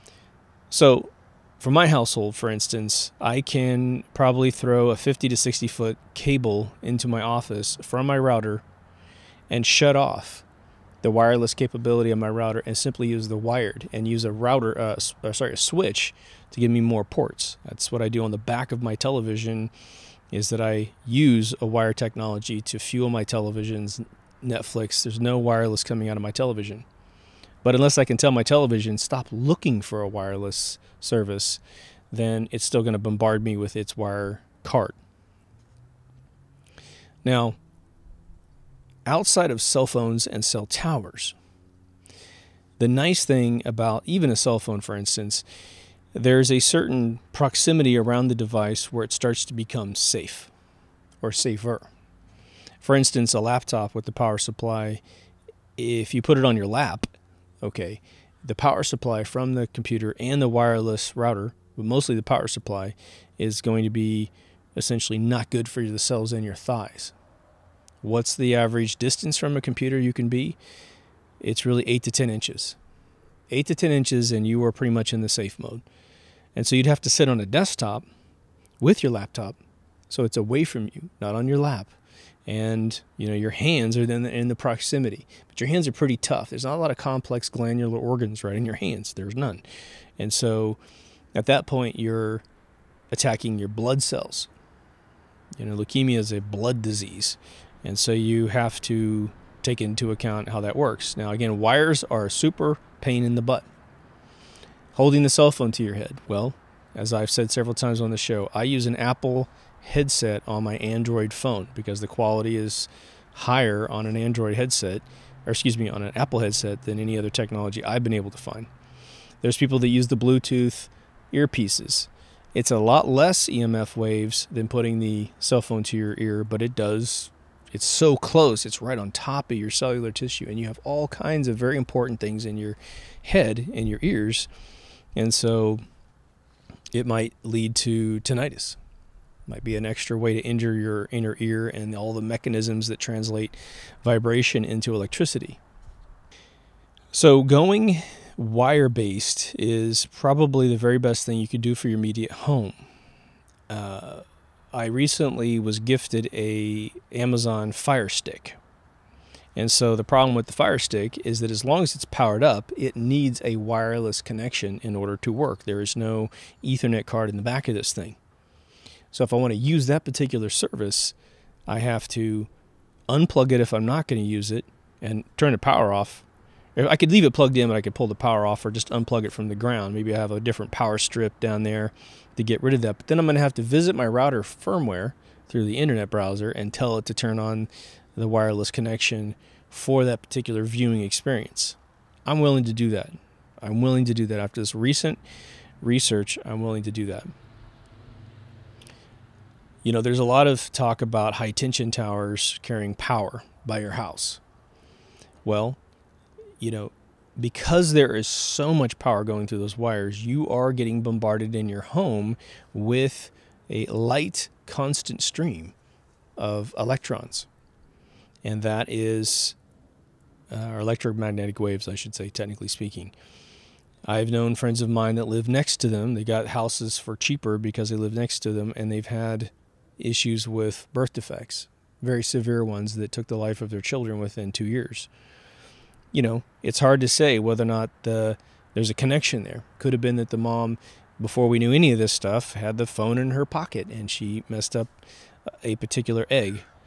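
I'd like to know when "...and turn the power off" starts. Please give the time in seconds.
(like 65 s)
175 s.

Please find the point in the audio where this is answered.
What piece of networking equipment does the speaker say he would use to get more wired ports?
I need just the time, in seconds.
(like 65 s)
15 s.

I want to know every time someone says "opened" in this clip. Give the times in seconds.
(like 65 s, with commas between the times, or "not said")
not said.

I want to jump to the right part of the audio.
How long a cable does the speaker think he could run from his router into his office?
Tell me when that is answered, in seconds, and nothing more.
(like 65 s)
4 s.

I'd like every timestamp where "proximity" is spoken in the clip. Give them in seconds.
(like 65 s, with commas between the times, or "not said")
47 s, 84 s.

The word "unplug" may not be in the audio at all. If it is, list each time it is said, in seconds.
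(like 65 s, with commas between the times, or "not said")
173 s, 178 s.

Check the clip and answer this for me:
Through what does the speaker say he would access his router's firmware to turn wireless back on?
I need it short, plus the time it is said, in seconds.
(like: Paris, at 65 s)
The internet browser, at 185 s.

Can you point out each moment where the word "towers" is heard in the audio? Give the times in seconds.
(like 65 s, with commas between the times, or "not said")
40 s, 201 s.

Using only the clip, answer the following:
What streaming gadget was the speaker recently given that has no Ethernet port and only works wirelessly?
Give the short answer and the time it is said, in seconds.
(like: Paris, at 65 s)
Amazon Fire Stick, at 157 s.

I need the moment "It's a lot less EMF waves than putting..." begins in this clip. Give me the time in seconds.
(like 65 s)
122 s.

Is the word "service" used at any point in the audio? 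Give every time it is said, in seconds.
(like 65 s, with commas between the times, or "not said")
30 s, 170 s.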